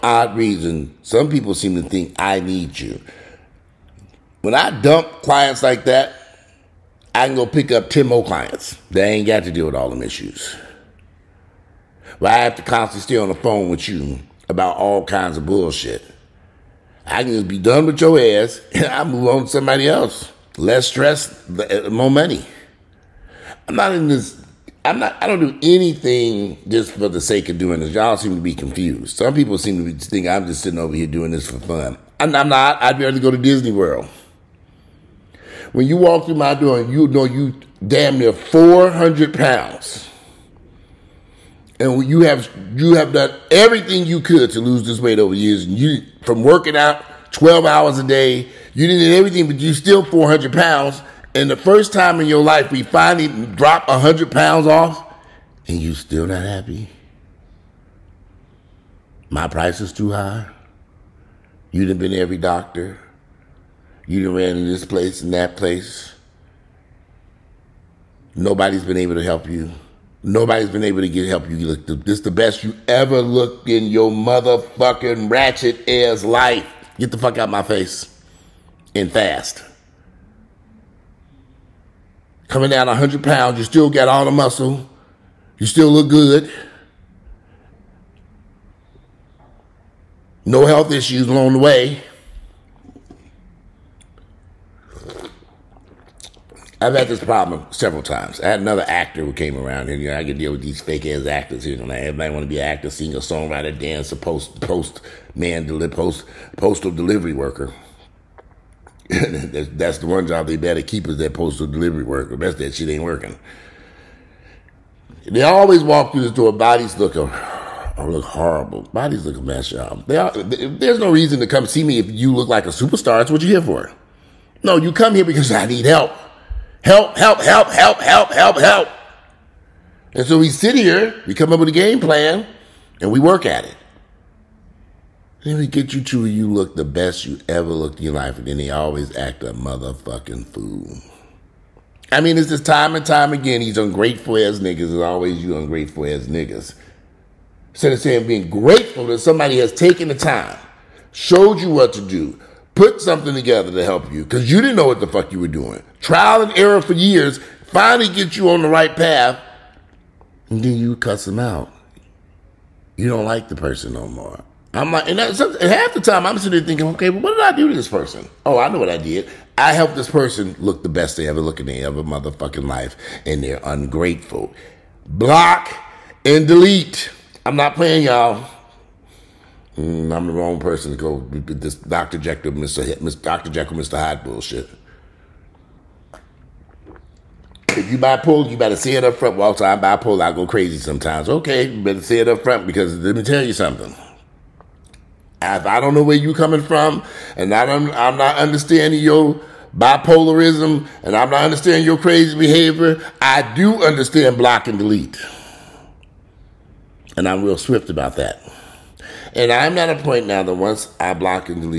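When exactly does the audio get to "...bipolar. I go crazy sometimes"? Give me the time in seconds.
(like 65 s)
189 s.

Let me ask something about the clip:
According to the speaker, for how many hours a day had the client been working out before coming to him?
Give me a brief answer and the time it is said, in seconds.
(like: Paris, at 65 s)
12 hours, at 47 s.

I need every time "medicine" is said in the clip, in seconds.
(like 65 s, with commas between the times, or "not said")
not said.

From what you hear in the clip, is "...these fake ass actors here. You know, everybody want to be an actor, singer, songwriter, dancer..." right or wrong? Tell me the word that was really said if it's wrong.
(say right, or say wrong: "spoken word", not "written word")
right.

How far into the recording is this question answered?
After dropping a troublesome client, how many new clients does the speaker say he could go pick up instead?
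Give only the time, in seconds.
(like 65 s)
7 s.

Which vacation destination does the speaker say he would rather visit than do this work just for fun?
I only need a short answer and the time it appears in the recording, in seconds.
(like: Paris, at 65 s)
Disney World, at 33 s.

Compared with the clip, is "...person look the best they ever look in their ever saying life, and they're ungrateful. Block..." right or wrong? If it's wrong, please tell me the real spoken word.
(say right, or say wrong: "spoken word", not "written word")
wrong: "motherfucking", not "saying".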